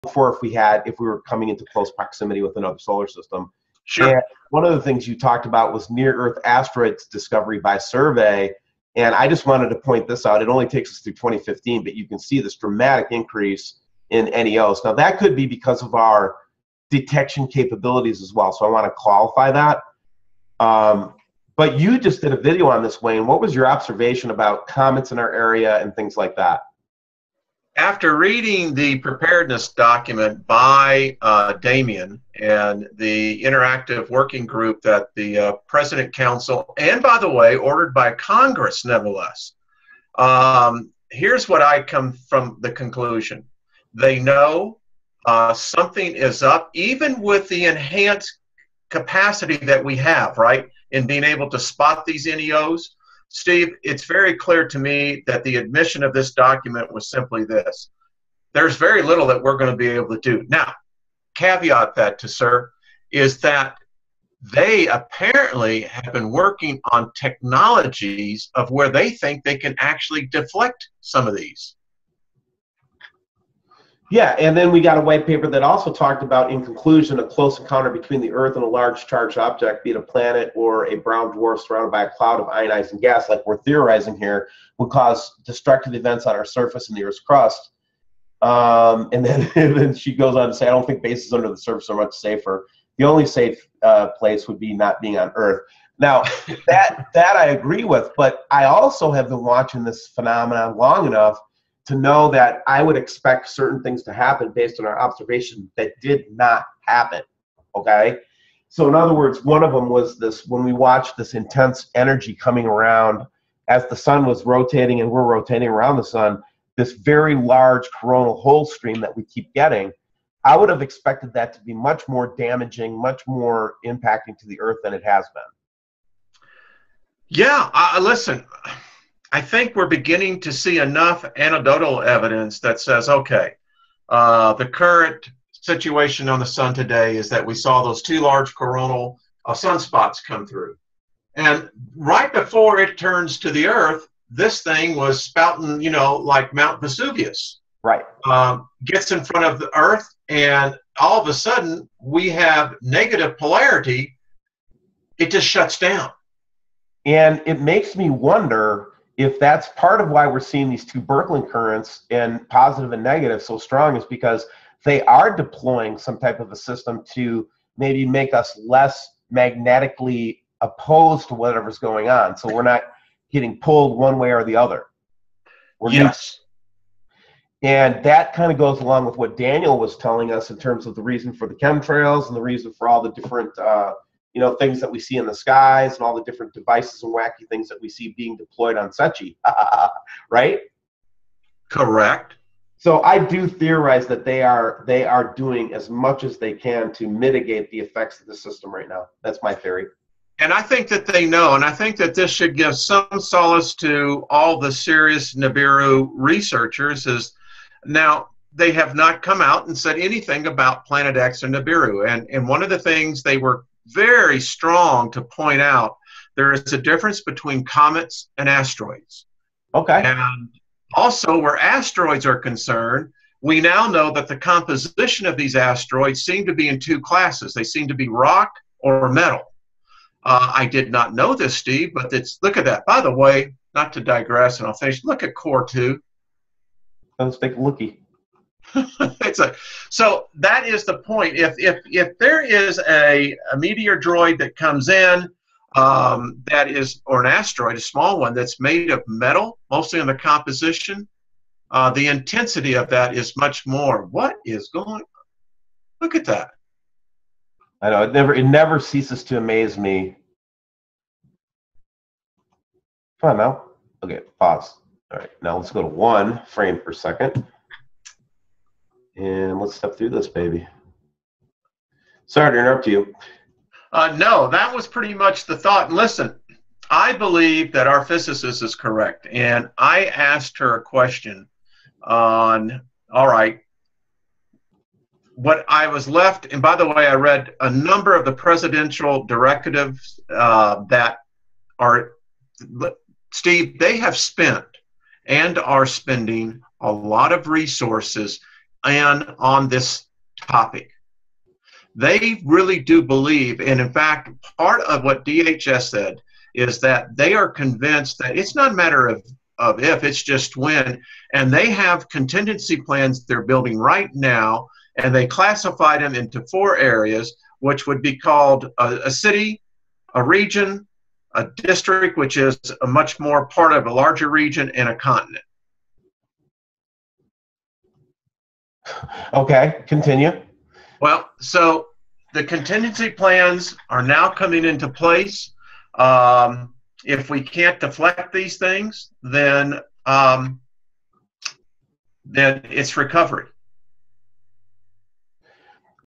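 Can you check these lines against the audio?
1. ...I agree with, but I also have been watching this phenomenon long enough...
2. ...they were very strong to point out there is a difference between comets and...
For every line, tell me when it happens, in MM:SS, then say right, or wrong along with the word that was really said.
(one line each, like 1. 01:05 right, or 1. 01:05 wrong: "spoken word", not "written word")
1. 01:37 right
2. 03:33 right.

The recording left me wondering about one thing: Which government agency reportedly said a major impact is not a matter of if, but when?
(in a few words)
DHS.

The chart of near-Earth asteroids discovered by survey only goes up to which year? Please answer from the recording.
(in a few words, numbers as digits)
2015.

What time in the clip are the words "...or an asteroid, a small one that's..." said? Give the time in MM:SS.
04:07.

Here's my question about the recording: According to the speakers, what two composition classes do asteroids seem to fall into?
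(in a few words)
Rock or metal.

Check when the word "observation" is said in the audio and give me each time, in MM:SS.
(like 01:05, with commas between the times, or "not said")
00:23, 01:44.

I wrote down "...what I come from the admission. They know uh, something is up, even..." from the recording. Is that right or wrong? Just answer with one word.
wrong.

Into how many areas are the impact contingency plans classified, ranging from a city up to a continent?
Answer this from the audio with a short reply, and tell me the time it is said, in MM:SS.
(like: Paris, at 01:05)
4, at 05:16.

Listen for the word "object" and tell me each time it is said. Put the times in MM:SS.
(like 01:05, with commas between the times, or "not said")
01:19.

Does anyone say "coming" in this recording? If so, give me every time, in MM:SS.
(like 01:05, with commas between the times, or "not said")
00:01, 01:52, 05:34.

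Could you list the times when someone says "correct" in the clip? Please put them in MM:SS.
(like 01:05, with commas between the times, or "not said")
03:11, 04:38.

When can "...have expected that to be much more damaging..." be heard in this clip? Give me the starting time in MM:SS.
02:00.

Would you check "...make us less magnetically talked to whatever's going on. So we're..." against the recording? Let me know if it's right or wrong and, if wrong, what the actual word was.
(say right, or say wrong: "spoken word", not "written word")
wrong: "opposed", not "talked".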